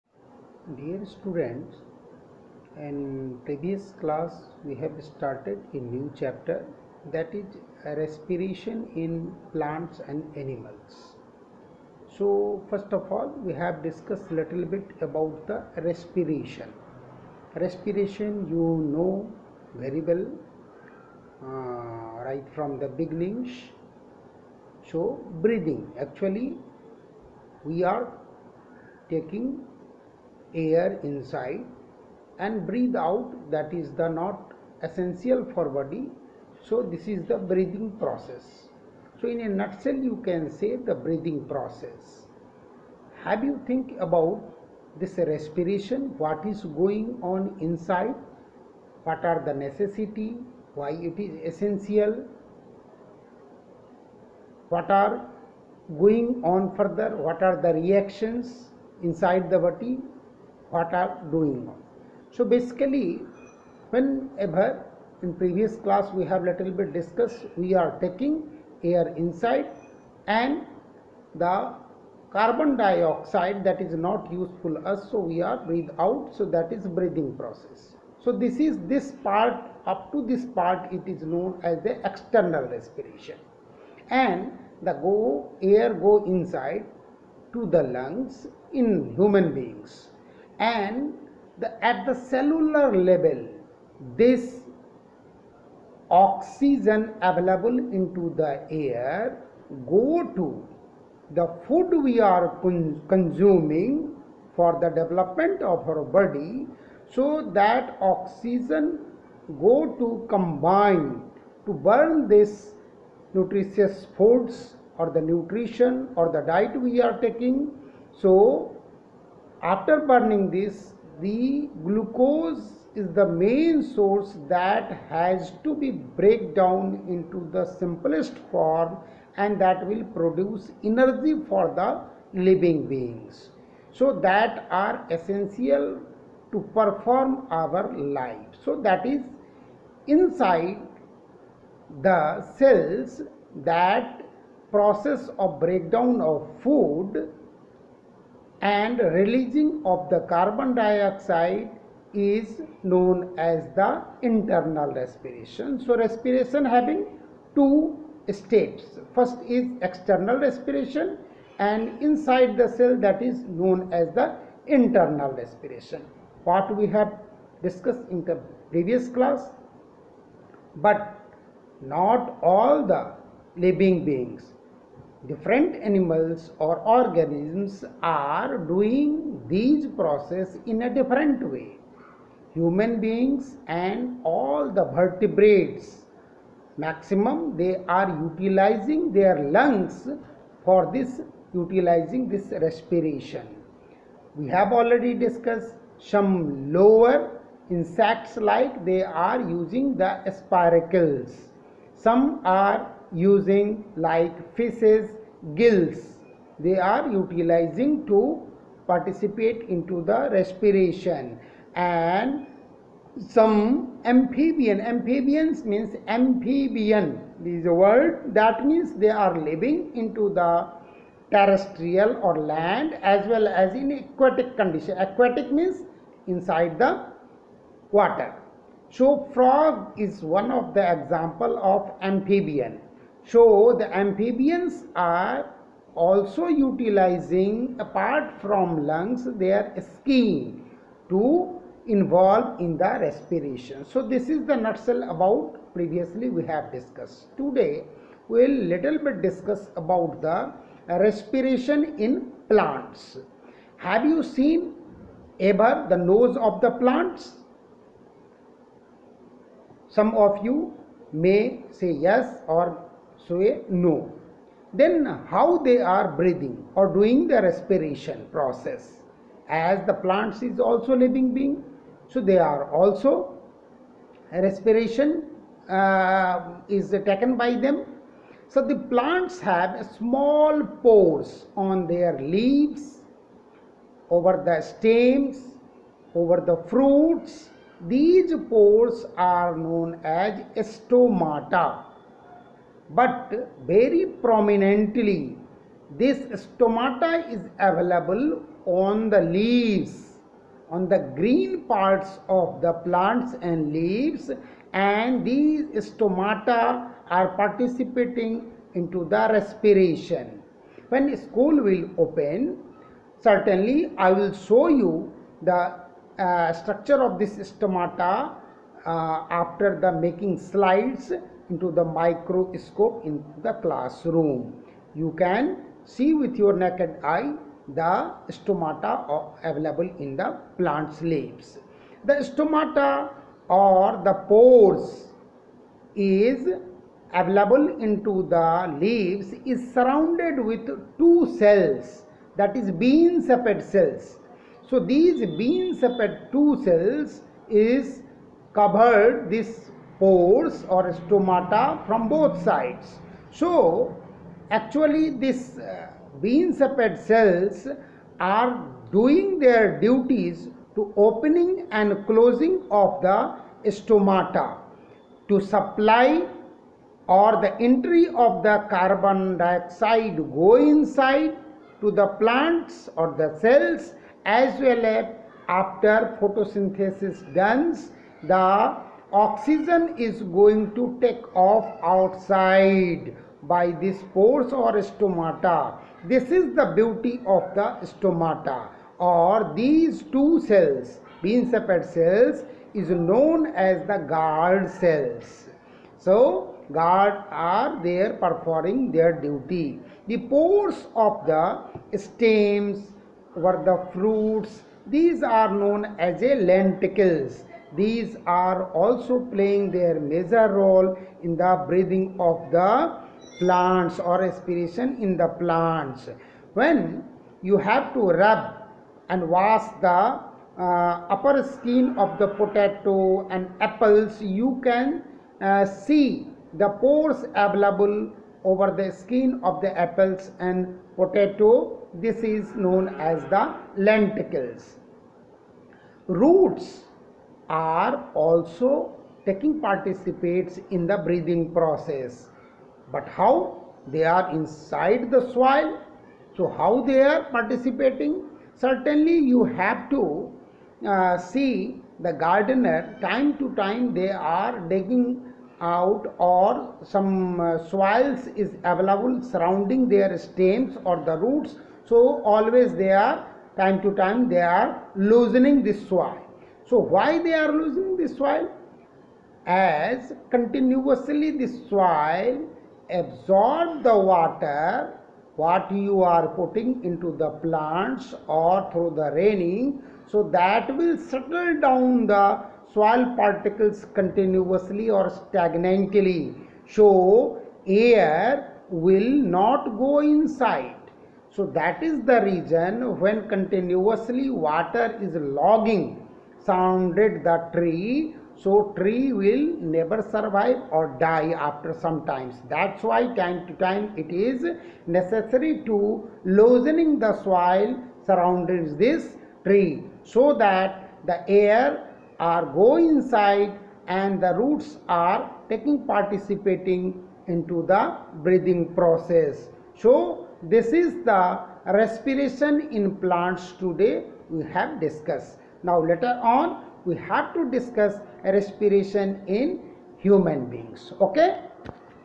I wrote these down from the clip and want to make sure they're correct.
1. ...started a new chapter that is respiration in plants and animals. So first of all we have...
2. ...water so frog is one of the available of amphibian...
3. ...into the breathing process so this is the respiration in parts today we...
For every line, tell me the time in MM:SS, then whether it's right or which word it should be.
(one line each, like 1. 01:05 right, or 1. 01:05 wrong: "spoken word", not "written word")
1. 00:05 right
2. 03:47 wrong: "example", not "available"
3. 08:37 wrong: "plants", not "parts".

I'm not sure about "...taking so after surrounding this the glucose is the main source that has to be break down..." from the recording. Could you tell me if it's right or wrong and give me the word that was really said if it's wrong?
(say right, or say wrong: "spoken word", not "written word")
wrong: "burning", not "surrounding".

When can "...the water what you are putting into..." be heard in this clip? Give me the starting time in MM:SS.
07:53.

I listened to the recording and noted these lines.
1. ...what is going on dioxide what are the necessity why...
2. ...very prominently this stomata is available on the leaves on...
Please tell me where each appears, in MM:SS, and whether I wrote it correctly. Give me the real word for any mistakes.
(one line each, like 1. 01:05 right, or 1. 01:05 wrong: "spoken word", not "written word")
1. 00:46 wrong: "inside", not "dioxide"
2. 04:53 right.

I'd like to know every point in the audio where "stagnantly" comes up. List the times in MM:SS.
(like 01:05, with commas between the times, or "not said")
08:05.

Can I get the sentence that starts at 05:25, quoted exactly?
You can see with your naked eye the stomata available in the plant's leaves.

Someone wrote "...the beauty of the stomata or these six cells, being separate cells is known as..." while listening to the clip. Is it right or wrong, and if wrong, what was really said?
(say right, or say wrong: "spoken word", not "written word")
wrong: "two", not "six".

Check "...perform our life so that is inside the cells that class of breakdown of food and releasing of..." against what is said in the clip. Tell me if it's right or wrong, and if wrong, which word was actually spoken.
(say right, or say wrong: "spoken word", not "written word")
wrong: "process", not "class".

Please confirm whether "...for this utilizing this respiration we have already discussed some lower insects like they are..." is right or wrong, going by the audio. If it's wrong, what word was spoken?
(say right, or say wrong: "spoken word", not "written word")
right.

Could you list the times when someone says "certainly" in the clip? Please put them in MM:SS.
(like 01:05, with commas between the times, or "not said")
05:13, 07:28.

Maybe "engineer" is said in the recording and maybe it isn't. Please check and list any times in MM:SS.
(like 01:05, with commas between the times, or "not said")
not said.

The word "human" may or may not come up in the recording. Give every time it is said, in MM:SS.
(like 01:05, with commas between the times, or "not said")
01:29, 03:02, 08:49.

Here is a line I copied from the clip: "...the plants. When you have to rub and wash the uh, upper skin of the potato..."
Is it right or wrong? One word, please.
right.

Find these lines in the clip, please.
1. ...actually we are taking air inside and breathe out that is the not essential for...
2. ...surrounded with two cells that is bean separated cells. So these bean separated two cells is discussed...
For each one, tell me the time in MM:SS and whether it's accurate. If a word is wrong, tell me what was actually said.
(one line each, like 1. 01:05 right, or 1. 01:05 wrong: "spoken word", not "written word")
1. 00:25 right
2. 05:39 wrong: "covered", not "discussed".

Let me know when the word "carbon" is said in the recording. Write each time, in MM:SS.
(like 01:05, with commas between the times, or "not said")
01:12, 02:30, 06:08.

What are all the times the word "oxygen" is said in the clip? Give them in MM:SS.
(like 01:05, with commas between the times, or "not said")
01:36, 01:48, 06:19.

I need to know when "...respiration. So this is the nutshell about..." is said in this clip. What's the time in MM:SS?
04:02.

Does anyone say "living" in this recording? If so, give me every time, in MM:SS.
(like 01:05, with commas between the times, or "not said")
02:12, 02:53, 03:39, 04:30.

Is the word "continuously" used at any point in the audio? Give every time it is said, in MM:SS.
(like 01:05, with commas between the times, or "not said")
07:50, 08:03, 08:13.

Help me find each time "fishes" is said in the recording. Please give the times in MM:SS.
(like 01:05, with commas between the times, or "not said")
03:24.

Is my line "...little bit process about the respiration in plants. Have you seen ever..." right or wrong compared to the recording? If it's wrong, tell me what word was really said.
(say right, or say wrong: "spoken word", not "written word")
wrong: "discuss", not "process".